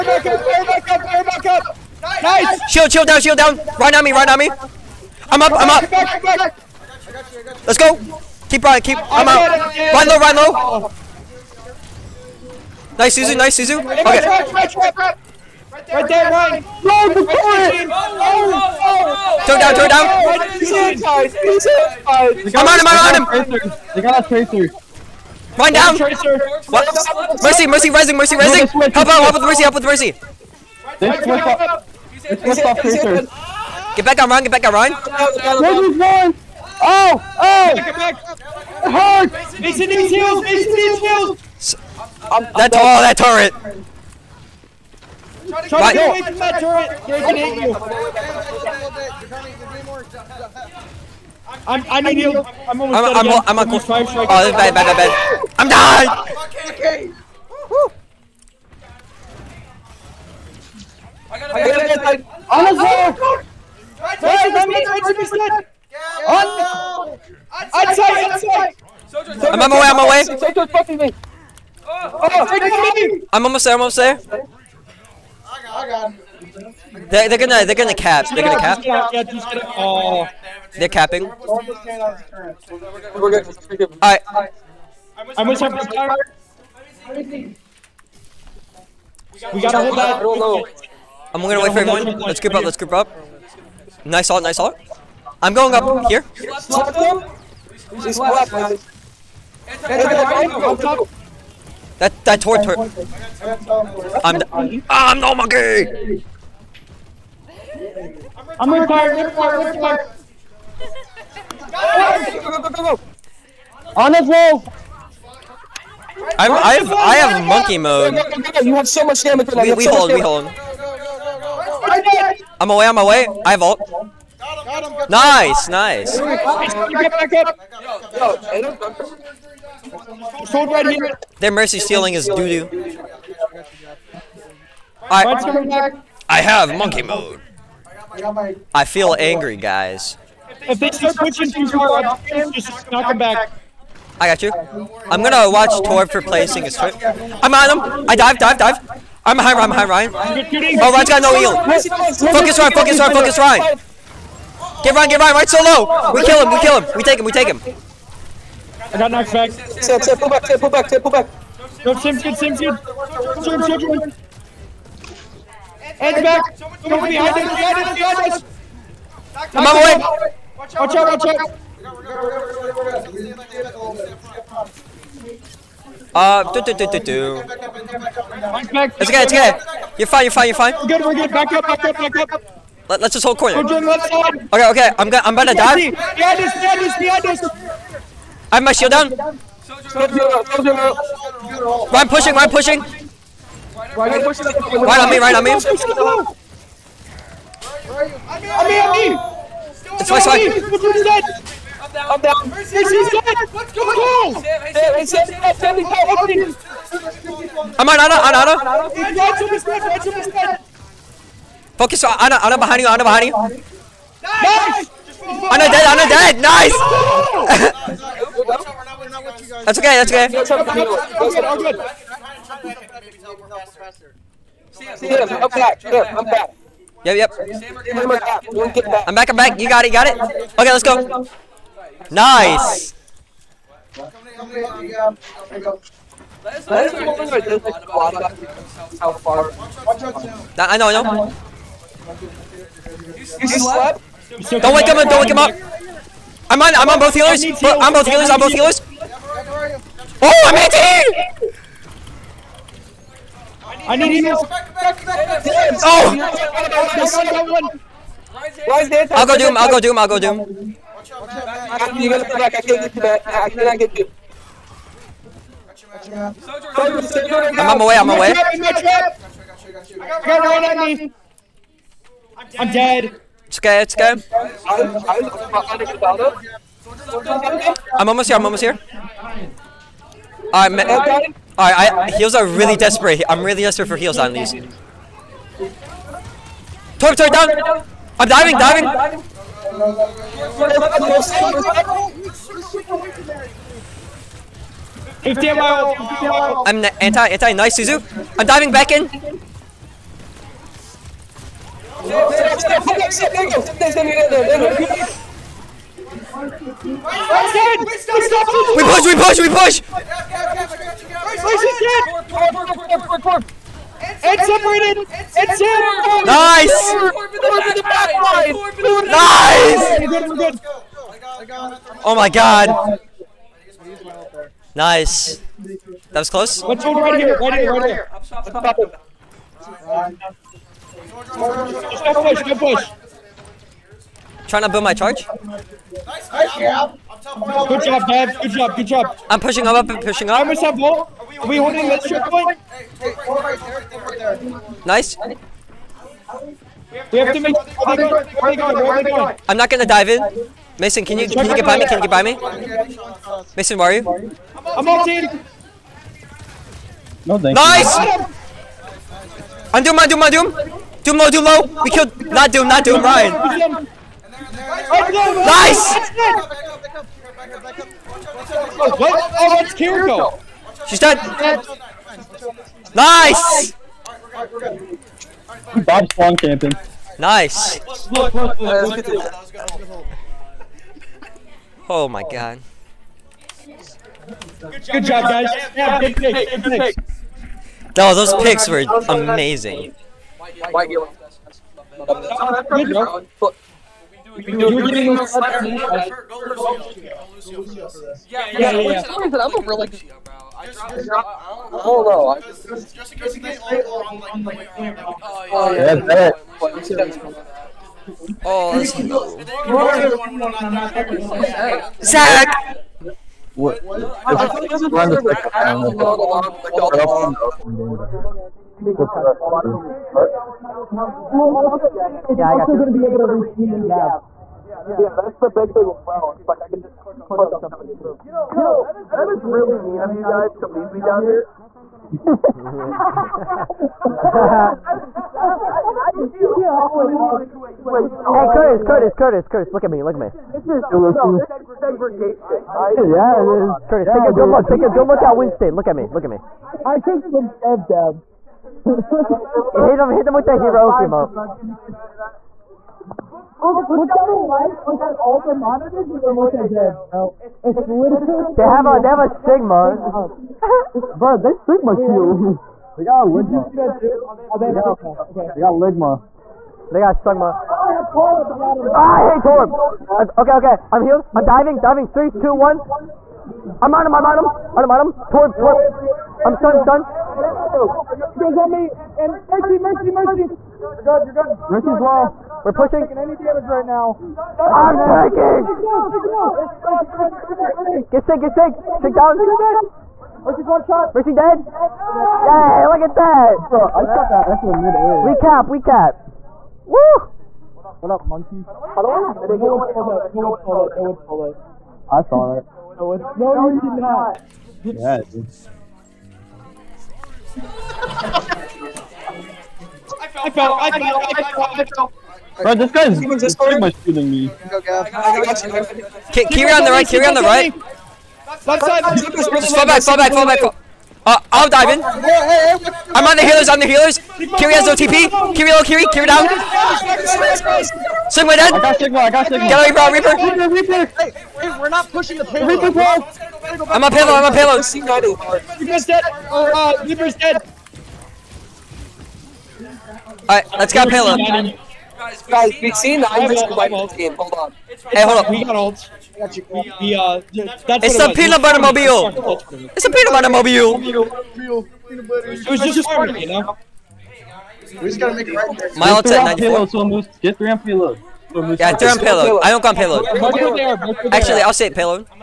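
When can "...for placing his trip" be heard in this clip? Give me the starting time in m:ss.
2:26.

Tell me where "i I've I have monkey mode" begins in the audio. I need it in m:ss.
1:56.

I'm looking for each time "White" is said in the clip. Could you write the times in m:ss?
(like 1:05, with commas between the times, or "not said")
6:30.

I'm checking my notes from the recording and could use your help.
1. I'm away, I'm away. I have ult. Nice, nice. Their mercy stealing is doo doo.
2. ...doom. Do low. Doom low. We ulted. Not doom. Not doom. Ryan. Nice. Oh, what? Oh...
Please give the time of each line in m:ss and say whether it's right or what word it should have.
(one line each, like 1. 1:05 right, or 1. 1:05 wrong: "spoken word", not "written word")
1. 2:02 right
2. 6:00 wrong: "killed", not "ulted".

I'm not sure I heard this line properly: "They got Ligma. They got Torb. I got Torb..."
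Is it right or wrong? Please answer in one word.
wrong.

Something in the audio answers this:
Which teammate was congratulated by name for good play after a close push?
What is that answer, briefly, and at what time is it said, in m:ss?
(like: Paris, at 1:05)
Dev, at 5:37.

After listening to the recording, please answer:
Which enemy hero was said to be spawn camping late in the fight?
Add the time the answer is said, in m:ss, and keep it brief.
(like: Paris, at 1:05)
Bob, at 6:15.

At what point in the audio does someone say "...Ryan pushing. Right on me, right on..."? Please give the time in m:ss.
3:12.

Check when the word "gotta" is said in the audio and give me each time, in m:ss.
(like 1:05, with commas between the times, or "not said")
1:29, 9:15.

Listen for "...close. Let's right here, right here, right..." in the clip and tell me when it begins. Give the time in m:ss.
5:26.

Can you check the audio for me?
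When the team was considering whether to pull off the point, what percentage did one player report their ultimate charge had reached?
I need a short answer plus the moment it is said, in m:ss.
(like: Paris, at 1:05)
94, at 9:15.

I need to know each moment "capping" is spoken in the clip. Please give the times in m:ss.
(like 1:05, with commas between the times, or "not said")
1:20.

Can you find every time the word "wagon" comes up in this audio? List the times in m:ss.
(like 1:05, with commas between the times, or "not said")
not said.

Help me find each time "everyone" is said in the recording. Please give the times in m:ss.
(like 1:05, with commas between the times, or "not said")
1:31.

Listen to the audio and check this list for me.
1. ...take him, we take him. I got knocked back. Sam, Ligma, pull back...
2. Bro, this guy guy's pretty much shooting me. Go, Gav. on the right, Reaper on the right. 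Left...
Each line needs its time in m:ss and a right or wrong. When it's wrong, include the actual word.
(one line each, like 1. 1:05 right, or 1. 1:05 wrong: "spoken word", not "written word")
1. 2:37 wrong: "Sam", not "Ligma"
2. 8:32 wrong: "Kiri", not "Reaper".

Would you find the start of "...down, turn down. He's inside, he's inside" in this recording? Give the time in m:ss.
0:19.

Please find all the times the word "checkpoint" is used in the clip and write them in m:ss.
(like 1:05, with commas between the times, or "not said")
5:42.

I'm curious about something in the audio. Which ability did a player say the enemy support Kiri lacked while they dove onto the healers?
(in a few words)
TP.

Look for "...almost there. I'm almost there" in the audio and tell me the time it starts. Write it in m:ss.
1:13.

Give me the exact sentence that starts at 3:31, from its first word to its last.
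Focus on Ana, Ana behind you, Ana behind you.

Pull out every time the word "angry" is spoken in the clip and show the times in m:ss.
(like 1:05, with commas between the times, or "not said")
2:19.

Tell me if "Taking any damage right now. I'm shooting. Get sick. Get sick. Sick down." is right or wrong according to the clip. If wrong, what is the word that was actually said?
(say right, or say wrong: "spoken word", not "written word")
wrong: "taking", not "shooting".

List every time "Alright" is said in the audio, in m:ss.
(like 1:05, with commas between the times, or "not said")
4:41, 9:00.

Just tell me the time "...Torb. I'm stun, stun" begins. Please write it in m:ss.
7:55.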